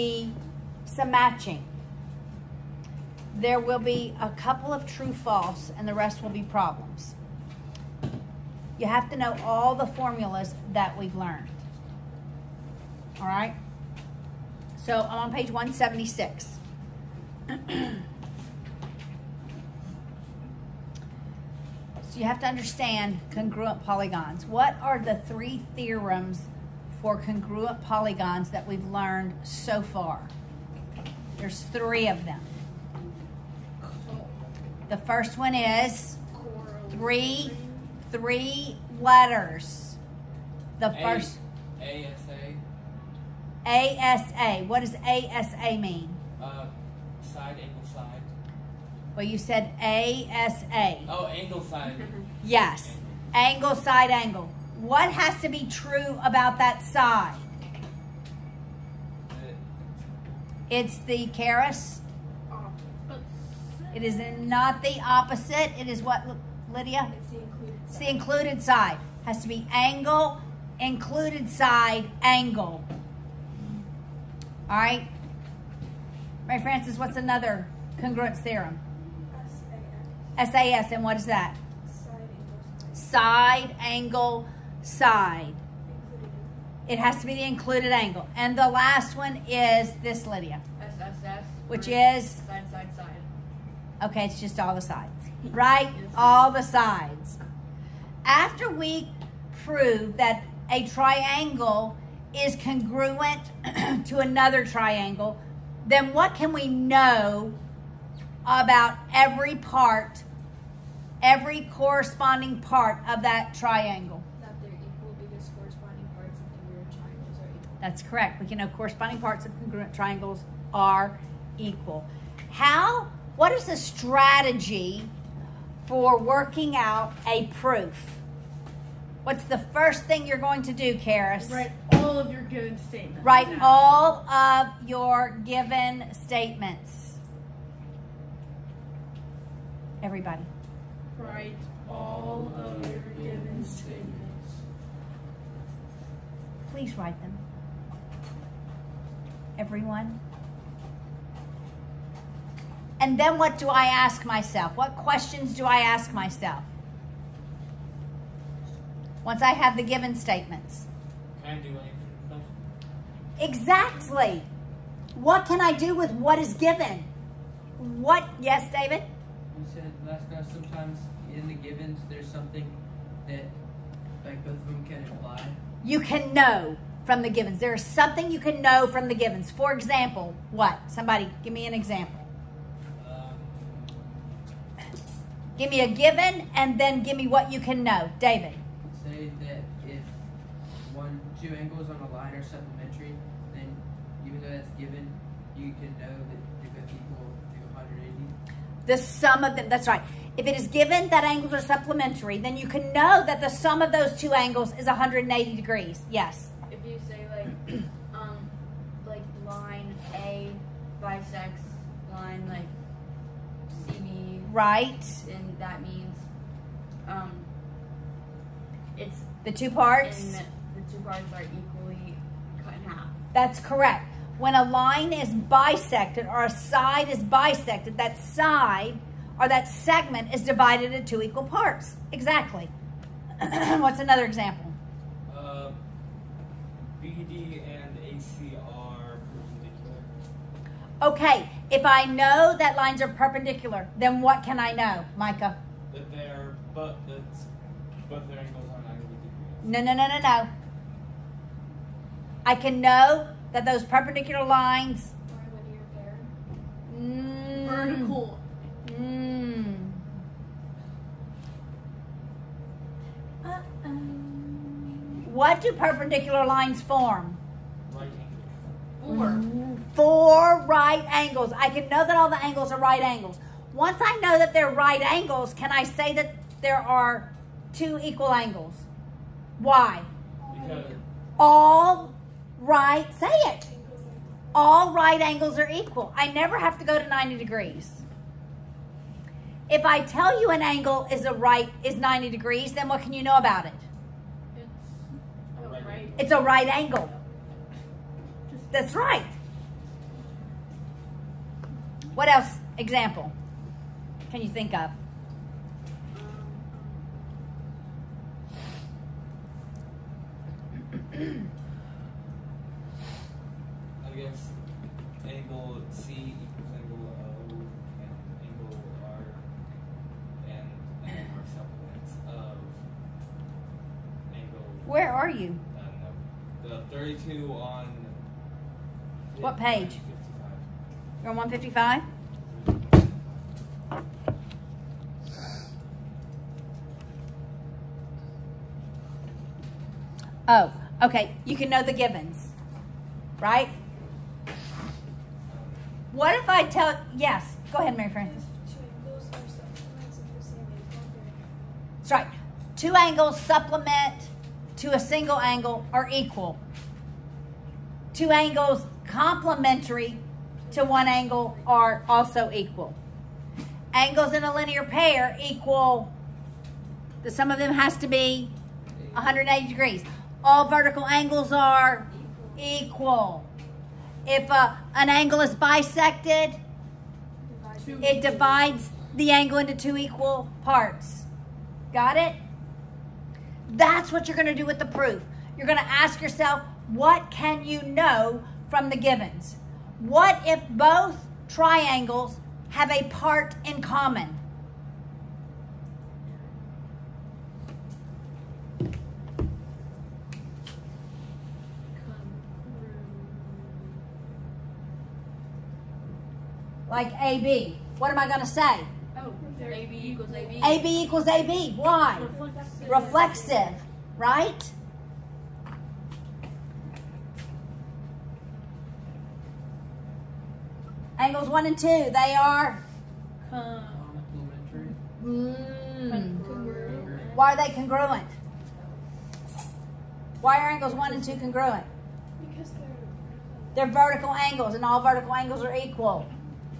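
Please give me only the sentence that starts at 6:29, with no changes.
What if both triangles have a part in common?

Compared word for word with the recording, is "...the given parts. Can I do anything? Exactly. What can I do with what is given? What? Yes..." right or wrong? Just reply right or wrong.
wrong.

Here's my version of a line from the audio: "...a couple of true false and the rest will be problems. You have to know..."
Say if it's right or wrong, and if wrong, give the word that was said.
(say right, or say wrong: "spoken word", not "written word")
right.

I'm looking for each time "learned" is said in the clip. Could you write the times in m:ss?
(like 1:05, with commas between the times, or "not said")
0:11, 0:28.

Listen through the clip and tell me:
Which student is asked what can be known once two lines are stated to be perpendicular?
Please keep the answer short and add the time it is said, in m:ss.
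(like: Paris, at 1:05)
Micah, at 4:05.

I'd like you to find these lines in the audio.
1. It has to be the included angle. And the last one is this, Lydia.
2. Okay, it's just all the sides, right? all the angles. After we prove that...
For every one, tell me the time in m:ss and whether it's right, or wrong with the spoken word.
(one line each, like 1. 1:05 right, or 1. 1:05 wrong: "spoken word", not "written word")
1. 1:26 right
2. 1:34 wrong: "sides", not "angles".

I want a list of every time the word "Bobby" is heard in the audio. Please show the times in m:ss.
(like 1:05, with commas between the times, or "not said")
not said.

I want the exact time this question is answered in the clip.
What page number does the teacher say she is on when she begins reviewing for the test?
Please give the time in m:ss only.
0:15.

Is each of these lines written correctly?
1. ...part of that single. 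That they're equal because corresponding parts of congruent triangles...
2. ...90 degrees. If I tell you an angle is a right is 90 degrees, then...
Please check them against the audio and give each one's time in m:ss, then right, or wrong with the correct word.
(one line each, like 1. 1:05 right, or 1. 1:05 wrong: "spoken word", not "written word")
1. 1:52 wrong: "triangle", not "single"
2. 4:47 right.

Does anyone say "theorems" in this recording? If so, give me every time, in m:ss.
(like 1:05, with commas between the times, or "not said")
0:25, 1:18.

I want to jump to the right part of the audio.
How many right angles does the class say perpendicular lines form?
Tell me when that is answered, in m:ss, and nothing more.
4:29.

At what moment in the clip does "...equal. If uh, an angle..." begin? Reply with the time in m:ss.
6:12.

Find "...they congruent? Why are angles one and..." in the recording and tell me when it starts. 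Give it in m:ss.
7:07.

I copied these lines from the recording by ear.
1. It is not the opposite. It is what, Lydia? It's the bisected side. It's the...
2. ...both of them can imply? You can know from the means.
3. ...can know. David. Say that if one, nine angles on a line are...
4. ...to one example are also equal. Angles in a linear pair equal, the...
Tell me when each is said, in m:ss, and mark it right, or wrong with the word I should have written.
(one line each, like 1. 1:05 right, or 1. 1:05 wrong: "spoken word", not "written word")
1. 1:03 wrong: "included", not "bisected"
2. 2:54 wrong: "givens", not "means"
3. 3:07 wrong: "two", not "nine"
4. 6:00 wrong: "angle", not "example".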